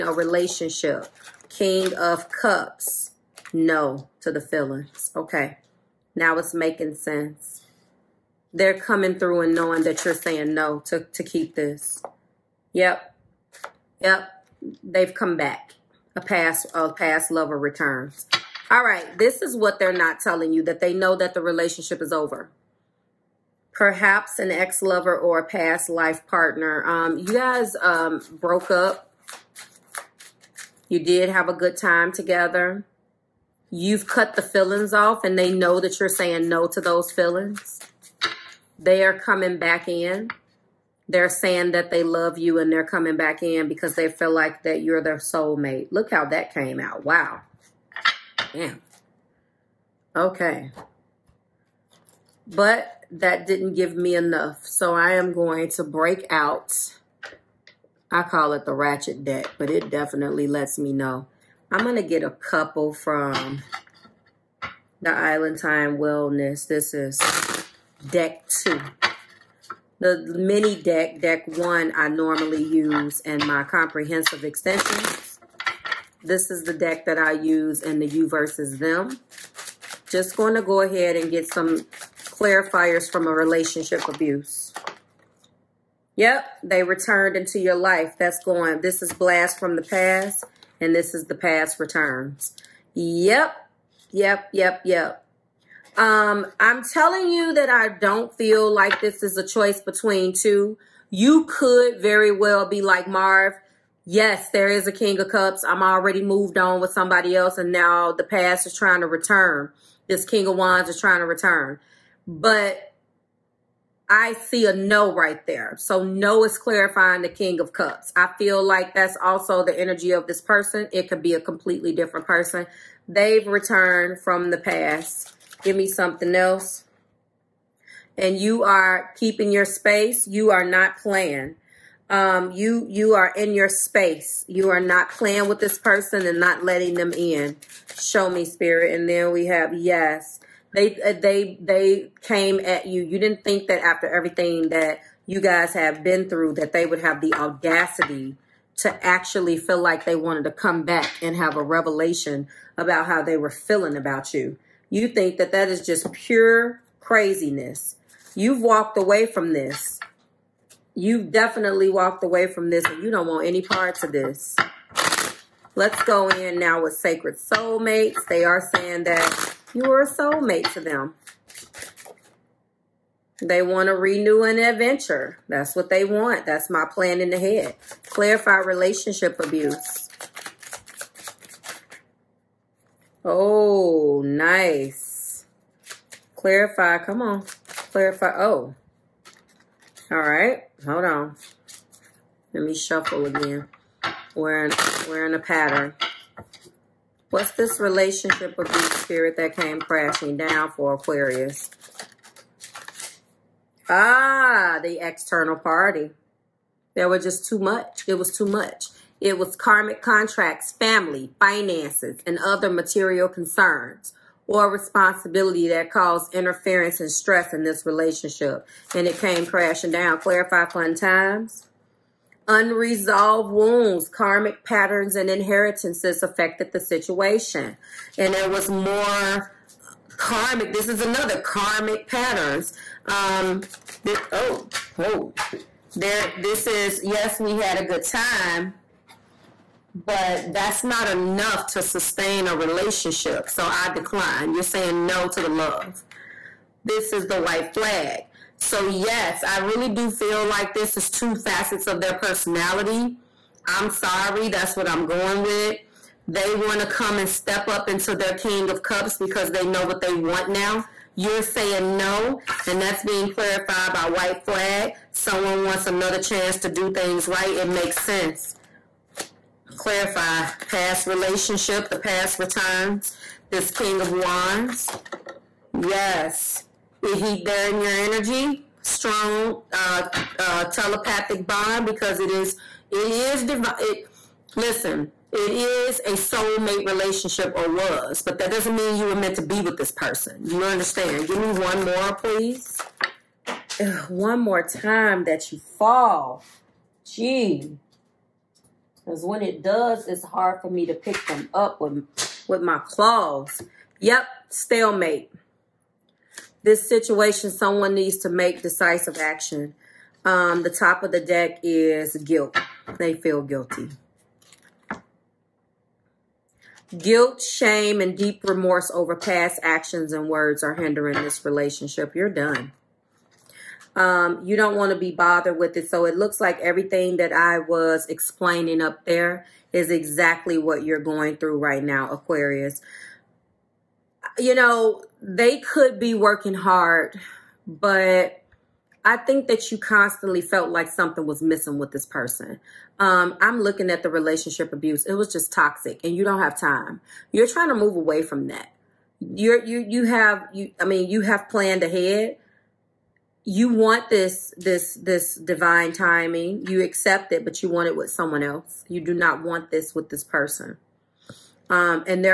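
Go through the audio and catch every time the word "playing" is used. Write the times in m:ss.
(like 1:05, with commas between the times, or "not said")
2:10, 2:15.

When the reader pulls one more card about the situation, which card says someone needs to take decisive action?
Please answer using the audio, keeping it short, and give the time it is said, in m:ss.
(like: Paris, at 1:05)
Stalemate, at 5:04.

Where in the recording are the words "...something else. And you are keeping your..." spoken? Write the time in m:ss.
2:05.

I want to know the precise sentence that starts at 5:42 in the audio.
Um, I'm looking at the relationship abuse.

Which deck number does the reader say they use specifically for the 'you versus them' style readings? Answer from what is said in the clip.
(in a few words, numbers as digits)
2.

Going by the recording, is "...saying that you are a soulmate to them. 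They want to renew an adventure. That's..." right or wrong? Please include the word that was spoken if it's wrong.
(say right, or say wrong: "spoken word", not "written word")
right.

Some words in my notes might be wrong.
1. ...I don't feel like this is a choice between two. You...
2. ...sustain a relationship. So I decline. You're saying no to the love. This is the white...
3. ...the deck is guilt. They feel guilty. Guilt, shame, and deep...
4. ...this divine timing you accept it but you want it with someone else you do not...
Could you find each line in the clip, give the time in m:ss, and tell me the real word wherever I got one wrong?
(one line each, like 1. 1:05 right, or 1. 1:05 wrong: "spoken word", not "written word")
1. 1:37 right
2. 4:01 right
3. 5:11 right
4. 5:54 right.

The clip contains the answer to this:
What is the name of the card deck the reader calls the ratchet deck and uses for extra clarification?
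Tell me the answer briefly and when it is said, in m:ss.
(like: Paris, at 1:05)
Island Time Wellness, at 1:05.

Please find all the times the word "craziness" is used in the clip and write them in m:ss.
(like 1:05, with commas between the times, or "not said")
2:37.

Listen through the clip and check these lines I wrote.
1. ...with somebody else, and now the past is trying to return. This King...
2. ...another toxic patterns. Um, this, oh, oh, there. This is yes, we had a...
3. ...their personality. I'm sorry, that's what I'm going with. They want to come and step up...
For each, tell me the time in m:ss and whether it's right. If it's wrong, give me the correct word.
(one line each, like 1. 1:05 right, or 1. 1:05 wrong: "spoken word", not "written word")
1. 1:46 right
2. 3:51 wrong: "karmic", not "toxic"
3. 4:12 right.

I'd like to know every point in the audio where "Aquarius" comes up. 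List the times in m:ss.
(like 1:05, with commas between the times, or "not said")
3:20, 5:32.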